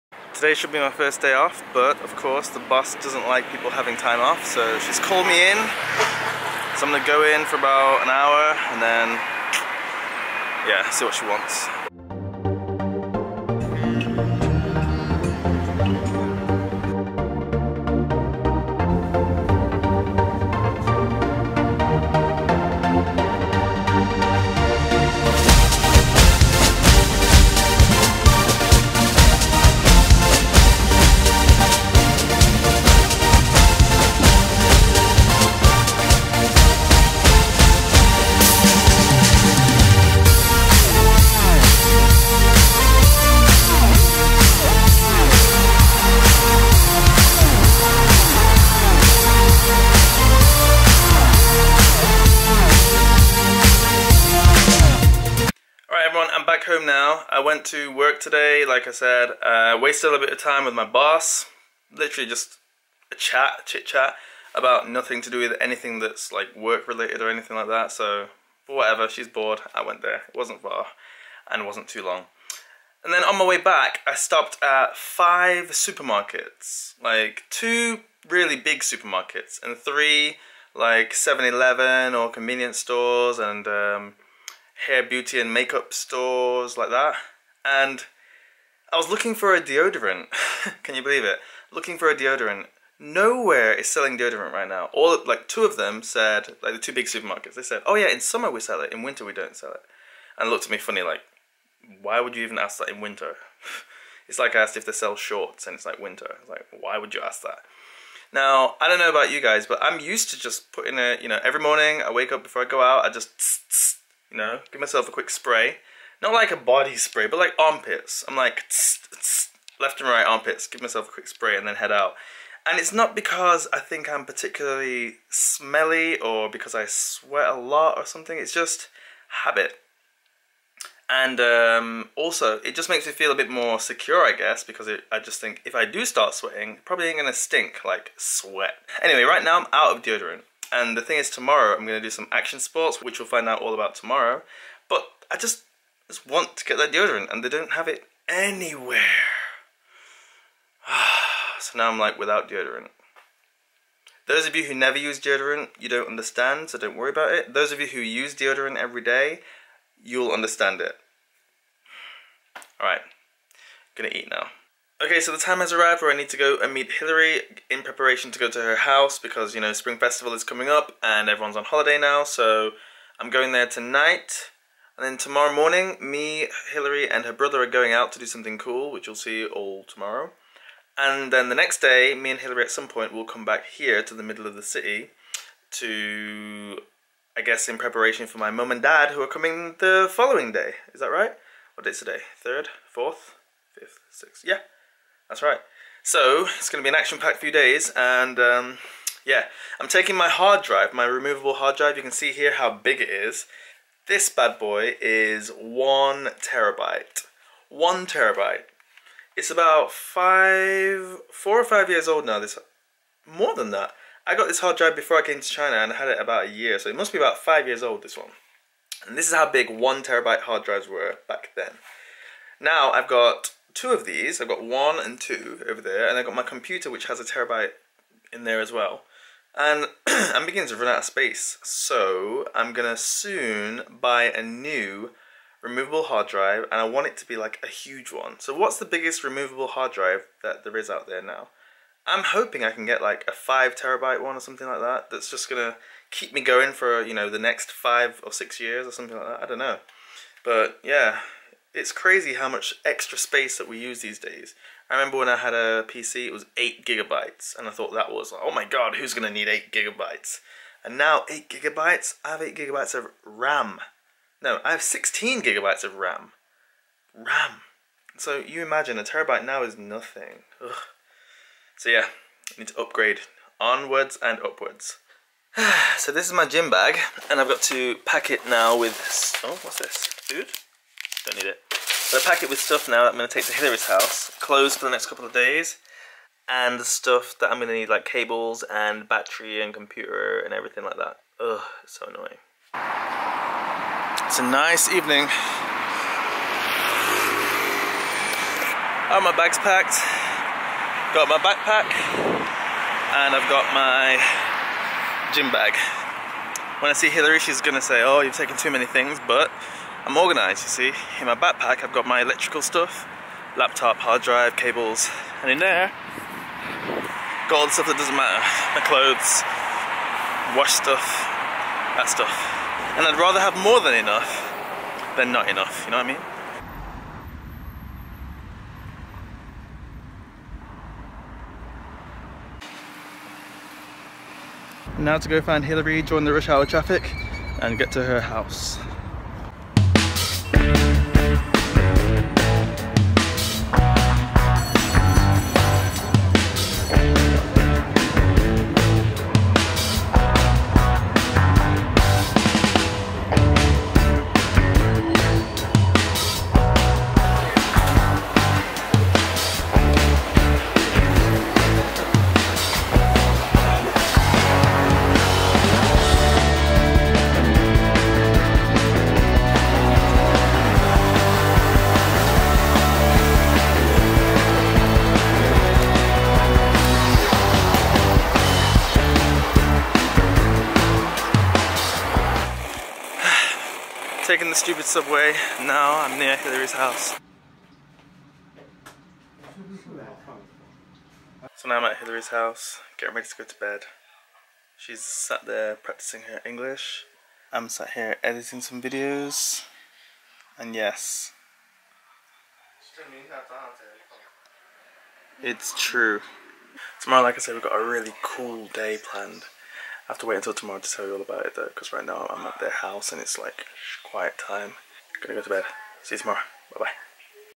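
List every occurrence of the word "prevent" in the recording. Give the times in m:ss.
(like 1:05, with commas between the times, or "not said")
not said.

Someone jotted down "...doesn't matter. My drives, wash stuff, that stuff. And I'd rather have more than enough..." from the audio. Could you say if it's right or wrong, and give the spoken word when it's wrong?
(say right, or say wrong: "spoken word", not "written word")
wrong: "clothes", not "drives".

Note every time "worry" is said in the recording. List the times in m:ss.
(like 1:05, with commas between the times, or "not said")
2:36.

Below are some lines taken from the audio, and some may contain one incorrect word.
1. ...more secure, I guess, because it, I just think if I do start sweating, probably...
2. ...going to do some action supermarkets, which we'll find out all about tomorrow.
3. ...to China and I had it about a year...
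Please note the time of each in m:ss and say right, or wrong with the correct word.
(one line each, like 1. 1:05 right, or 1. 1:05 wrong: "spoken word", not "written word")
1. 2:13 right
2. 2:21 wrong: "sports", not "supermarkets"
3. 3:35 right.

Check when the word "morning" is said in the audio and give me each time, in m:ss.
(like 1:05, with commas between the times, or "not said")
1:51, 2:55.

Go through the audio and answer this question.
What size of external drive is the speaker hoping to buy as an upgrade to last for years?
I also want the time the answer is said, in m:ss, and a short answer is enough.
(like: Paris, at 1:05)
5 terabytes, at 4:03.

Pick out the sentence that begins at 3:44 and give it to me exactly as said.
I've got one and two over there, and I've got my computer, which has a terabyte in there as well.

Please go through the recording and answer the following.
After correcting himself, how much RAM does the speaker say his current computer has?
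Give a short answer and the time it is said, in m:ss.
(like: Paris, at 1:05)
16 gigabytes, at 4:24.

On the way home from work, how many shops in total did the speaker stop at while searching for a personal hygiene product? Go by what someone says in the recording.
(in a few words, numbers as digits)
5.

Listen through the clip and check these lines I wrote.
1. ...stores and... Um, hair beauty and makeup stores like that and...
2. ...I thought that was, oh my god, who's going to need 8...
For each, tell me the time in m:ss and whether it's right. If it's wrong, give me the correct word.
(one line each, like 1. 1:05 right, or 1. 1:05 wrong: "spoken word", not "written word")
1. 1:22 right
2. 4:17 right.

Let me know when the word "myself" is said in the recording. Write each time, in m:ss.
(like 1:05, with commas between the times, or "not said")
1:54, 2:00.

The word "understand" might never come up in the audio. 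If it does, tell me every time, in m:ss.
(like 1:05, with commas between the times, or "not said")
2:36, 2:40.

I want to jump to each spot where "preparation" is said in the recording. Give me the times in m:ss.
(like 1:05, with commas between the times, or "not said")
2:47, 3:07.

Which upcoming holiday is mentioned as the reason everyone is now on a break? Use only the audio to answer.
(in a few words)
Spring Festival.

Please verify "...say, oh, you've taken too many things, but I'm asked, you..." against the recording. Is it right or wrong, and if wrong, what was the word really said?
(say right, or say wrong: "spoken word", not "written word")
wrong: "organised", not "asked".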